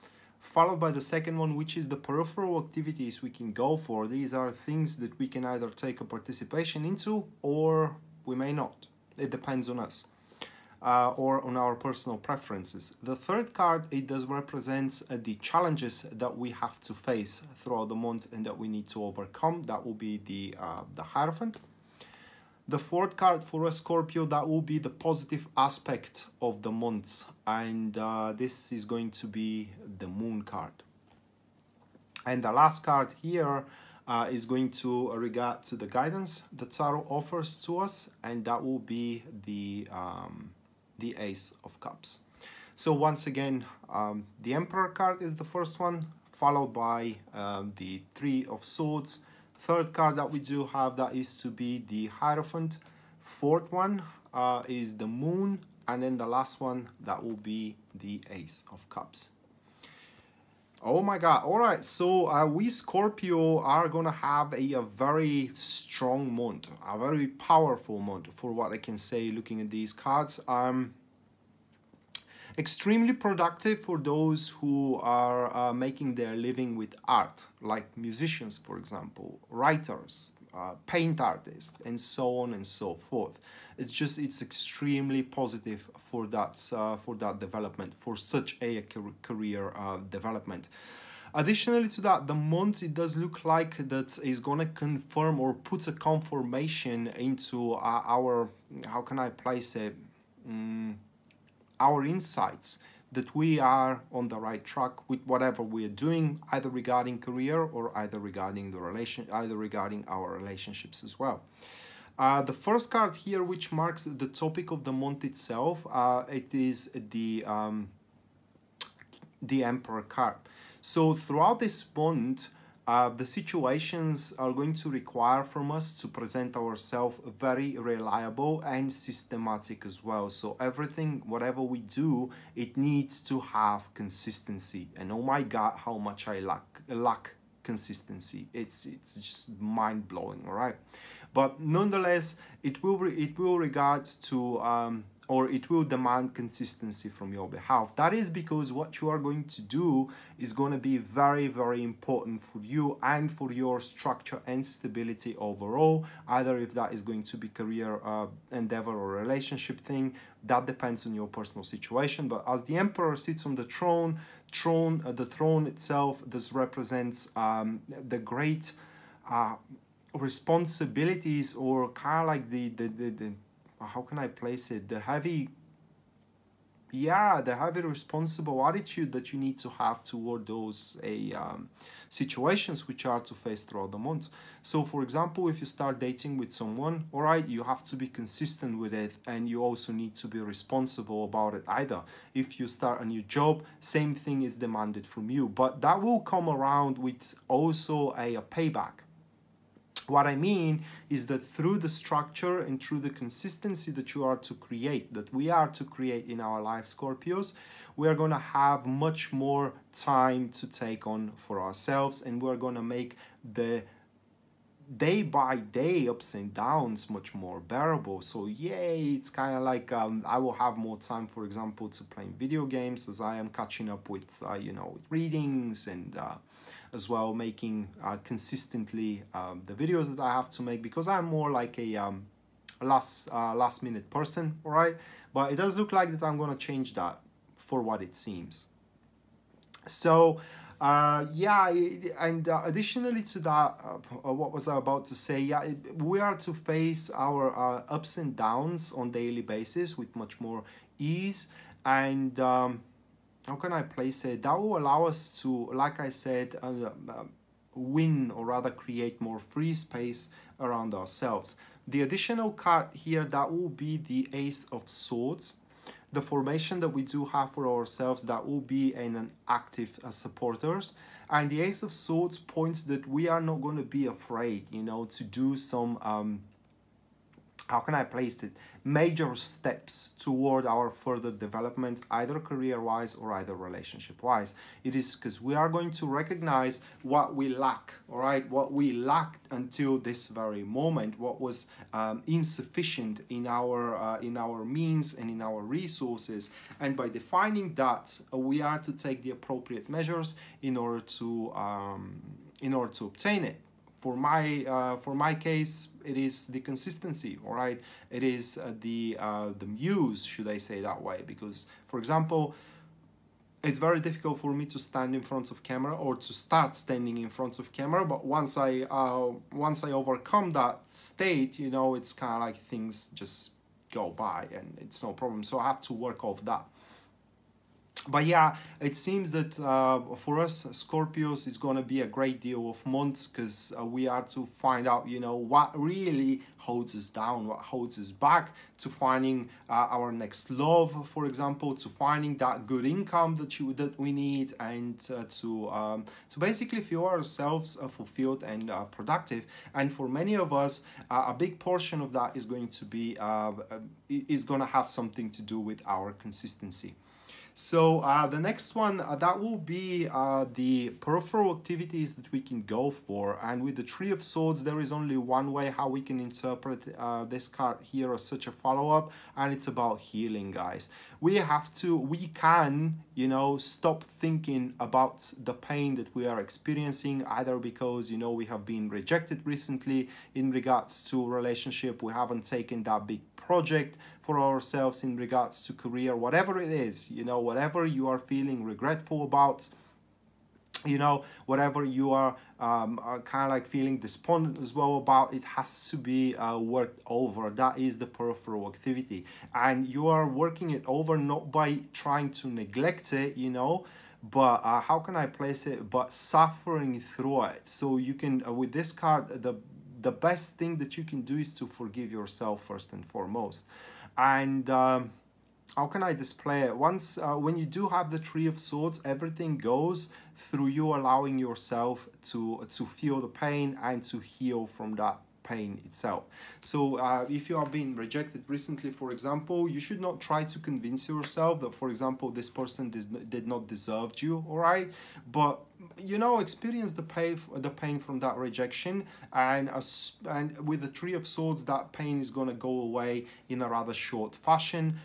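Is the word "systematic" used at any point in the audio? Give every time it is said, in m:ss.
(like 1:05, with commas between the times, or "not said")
2:08.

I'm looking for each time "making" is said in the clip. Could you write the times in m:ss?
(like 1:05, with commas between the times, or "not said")
1:15, 3:47.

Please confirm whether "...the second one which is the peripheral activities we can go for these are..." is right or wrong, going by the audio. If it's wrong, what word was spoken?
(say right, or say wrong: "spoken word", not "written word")
right.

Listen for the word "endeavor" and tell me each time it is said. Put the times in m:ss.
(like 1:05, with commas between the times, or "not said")
2:38.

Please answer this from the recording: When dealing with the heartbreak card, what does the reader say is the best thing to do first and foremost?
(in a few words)
Forgive yourself.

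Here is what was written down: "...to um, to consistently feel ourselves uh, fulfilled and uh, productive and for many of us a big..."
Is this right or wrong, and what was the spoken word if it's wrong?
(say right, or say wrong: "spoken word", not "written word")
wrong: "basically", not "consistently".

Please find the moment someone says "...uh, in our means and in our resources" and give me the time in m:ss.
4:53.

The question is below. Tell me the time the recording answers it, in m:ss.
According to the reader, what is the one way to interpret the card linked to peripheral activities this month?
6:09.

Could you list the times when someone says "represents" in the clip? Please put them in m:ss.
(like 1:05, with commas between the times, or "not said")
0:14, 2:46.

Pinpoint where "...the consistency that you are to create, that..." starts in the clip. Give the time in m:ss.
3:22.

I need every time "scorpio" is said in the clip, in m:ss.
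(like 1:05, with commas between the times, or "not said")
0:23, 1:02, 3:26, 5:30.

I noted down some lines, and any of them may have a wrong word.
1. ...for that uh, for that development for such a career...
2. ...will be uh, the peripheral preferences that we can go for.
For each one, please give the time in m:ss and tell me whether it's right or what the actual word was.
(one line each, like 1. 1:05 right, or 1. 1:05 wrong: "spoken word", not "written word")
1. 1:25 right
2. 5:59 wrong: "activities", not "preferences".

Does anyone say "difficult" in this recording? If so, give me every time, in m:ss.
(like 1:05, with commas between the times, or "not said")
5:13.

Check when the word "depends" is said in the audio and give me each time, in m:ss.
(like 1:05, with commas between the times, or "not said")
0:09, 2:40.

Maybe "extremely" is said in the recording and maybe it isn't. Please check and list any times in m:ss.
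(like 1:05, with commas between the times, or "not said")
1:12, 1:24.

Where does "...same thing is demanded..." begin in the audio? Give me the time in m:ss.
3:13.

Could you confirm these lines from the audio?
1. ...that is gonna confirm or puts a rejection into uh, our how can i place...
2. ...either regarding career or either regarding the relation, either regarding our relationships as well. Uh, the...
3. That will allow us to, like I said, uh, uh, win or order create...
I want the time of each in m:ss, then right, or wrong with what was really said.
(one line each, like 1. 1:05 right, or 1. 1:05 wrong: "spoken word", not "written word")
1. 1:33 wrong: "confirmation", not "rejection"
2. 1:46 right
3. 4:14 wrong: "rather", not "order".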